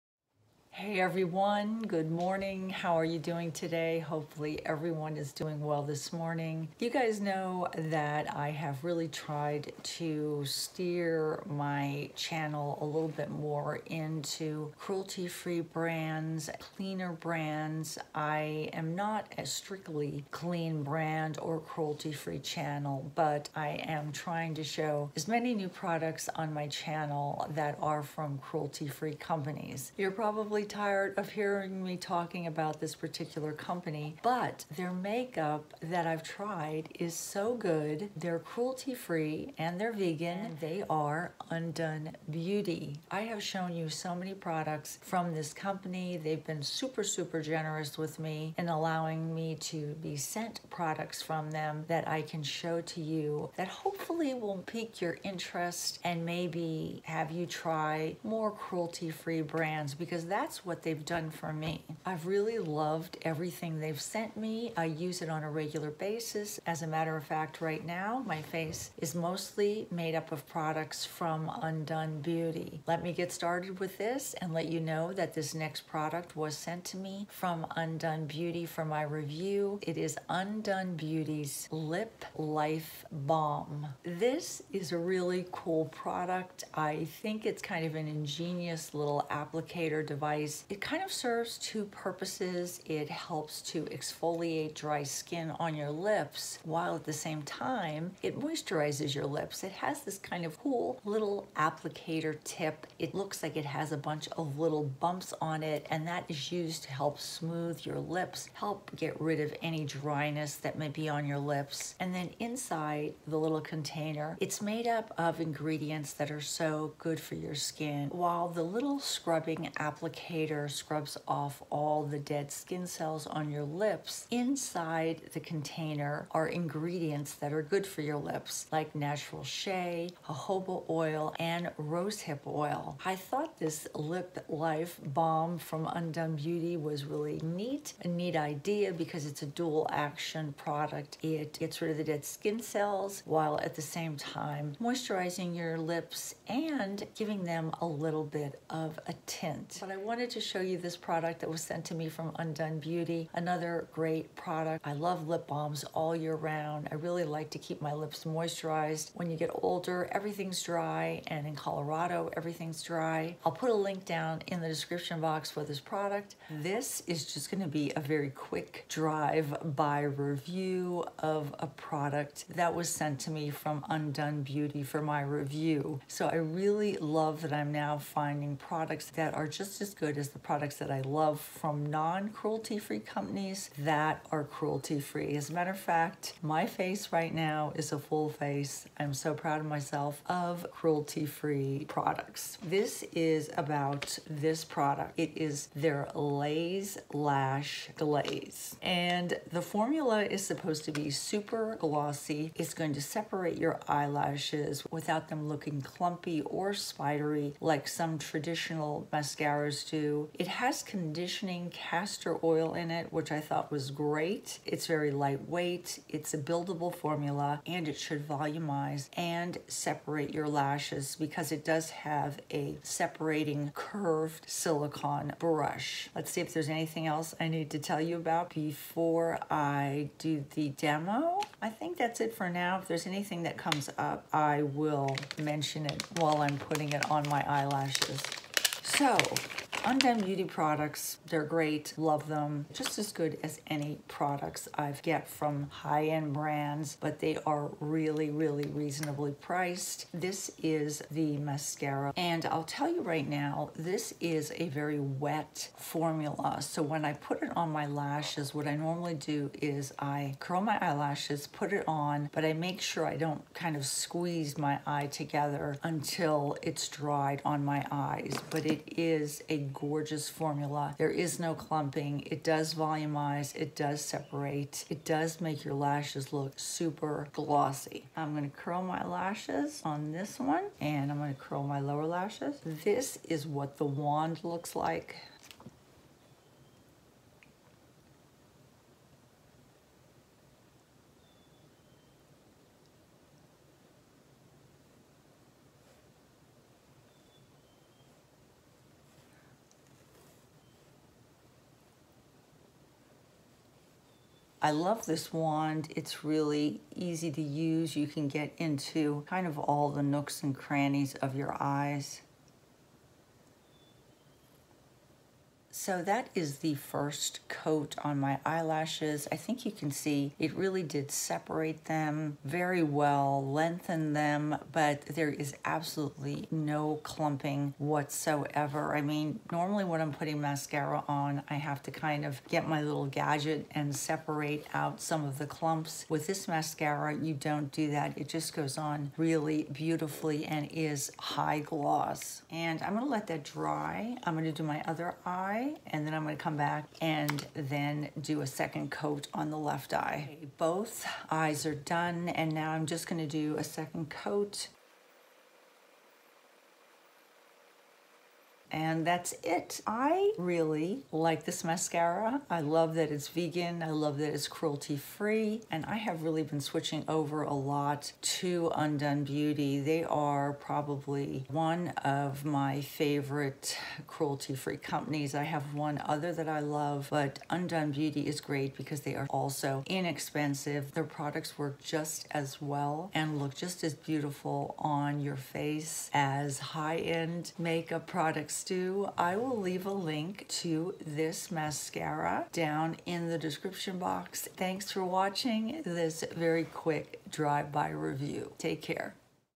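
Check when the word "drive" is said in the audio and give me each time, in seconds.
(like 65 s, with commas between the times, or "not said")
168 s, 397 s.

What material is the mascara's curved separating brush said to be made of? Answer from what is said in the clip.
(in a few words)
Silicone.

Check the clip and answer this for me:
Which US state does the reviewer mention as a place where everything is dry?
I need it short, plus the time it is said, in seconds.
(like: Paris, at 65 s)
Colorado, at 161 s.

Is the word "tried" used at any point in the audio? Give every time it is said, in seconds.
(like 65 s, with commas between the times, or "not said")
9 s, 36 s.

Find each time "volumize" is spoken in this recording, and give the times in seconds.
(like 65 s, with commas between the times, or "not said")
218 s, 272 s.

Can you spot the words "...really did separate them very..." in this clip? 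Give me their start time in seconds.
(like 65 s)
320 s.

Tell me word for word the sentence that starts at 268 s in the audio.
But it is a gorgeous formula.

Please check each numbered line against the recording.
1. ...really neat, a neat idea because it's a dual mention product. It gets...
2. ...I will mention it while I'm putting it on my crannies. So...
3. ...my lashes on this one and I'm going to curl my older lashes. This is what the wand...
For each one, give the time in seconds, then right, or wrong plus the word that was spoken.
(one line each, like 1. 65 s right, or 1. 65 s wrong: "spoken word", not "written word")
1. 137 s wrong: "action", not "mention"
2. 234 s wrong: "eyelashes", not "crannies"
3. 278 s wrong: "lower", not "older".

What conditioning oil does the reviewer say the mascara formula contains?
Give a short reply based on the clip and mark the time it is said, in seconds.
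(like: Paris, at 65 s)
Castor oil, at 211 s.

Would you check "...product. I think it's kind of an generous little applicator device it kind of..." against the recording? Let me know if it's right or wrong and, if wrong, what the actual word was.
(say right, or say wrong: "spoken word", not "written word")
wrong: "ingenious", not "generous".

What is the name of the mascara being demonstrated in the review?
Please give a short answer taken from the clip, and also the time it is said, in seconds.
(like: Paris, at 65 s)
Laze Lash Glaze, at 196 s.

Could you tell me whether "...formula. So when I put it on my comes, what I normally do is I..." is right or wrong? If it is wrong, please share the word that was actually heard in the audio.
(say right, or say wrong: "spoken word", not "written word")
wrong: "lashes", not "comes".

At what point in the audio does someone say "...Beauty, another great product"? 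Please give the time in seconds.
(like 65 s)
152 s.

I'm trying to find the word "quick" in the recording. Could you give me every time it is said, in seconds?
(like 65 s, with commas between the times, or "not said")
168 s, 396 s.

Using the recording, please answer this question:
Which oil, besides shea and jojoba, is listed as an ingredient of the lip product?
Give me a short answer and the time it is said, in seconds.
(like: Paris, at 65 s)
Rosehip oil, at 131 s.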